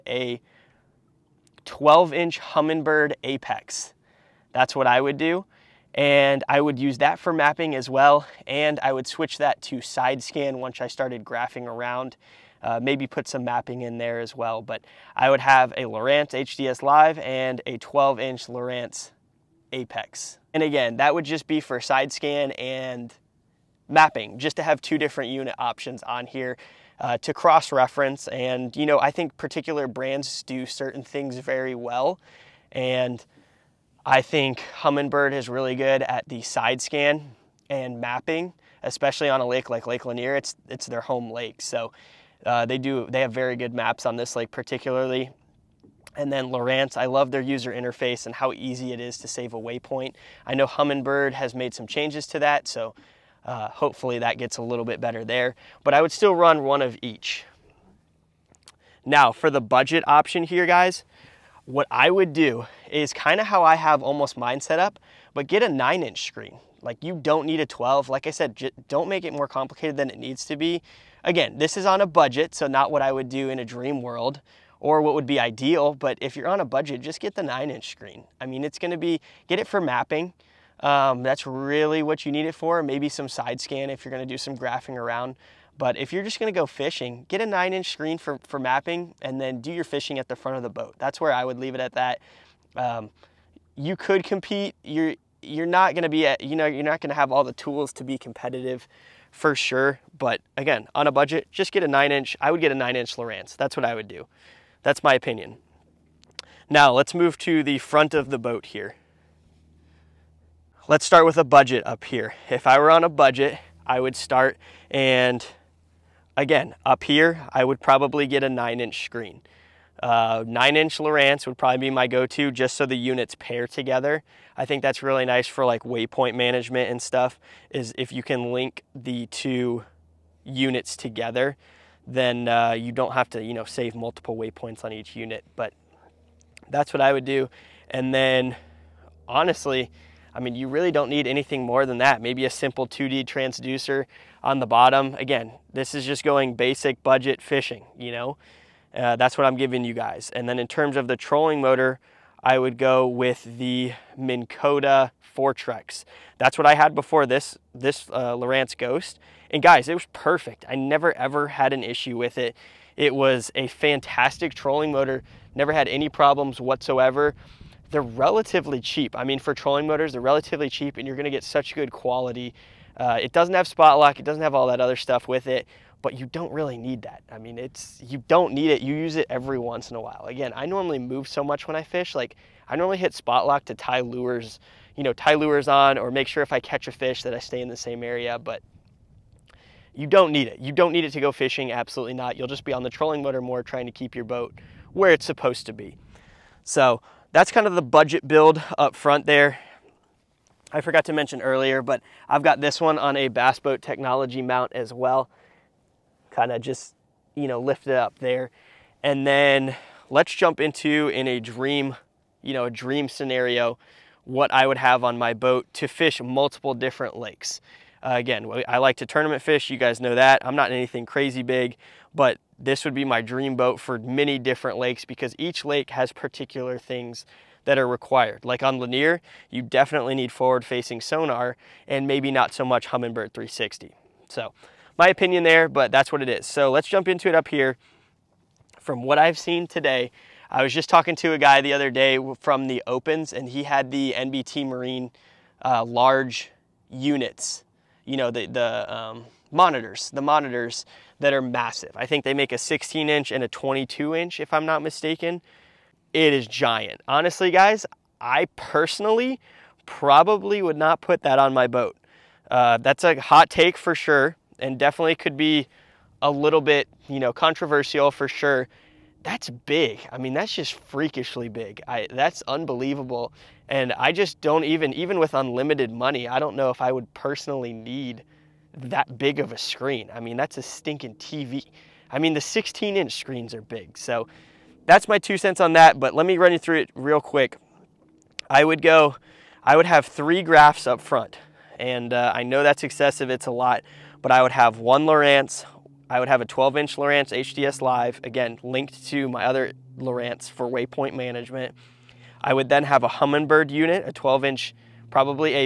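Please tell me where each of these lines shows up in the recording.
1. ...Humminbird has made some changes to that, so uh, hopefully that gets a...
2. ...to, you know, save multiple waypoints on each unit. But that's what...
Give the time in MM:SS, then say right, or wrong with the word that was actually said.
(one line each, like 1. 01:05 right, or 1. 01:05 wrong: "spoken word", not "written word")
1. 00:50 right
2. 02:13 right.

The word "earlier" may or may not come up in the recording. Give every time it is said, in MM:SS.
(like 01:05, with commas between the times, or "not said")
03:21.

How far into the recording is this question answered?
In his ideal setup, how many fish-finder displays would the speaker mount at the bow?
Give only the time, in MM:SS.
04:50.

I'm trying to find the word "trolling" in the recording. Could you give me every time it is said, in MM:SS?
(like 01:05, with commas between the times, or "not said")
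02:31, 02:44, 02:49, 03:12.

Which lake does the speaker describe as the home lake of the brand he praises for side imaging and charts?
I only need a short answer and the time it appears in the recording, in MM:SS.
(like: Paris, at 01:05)
Lake Lanier, at 00:39.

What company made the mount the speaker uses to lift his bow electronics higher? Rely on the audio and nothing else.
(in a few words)
Bass Boat Technology.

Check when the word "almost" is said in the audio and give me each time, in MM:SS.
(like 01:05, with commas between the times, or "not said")
01:04.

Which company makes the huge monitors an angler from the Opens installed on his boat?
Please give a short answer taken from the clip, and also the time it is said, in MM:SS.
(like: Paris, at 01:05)
NBT Marine, at 04:04.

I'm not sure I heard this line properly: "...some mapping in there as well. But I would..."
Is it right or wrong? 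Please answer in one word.
right.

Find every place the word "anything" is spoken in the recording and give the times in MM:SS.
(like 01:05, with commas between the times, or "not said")
02:21, 03:40.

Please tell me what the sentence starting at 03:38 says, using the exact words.
Uh, again, I like to tournament fish.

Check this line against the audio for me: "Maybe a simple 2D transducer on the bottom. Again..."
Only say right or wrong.
right.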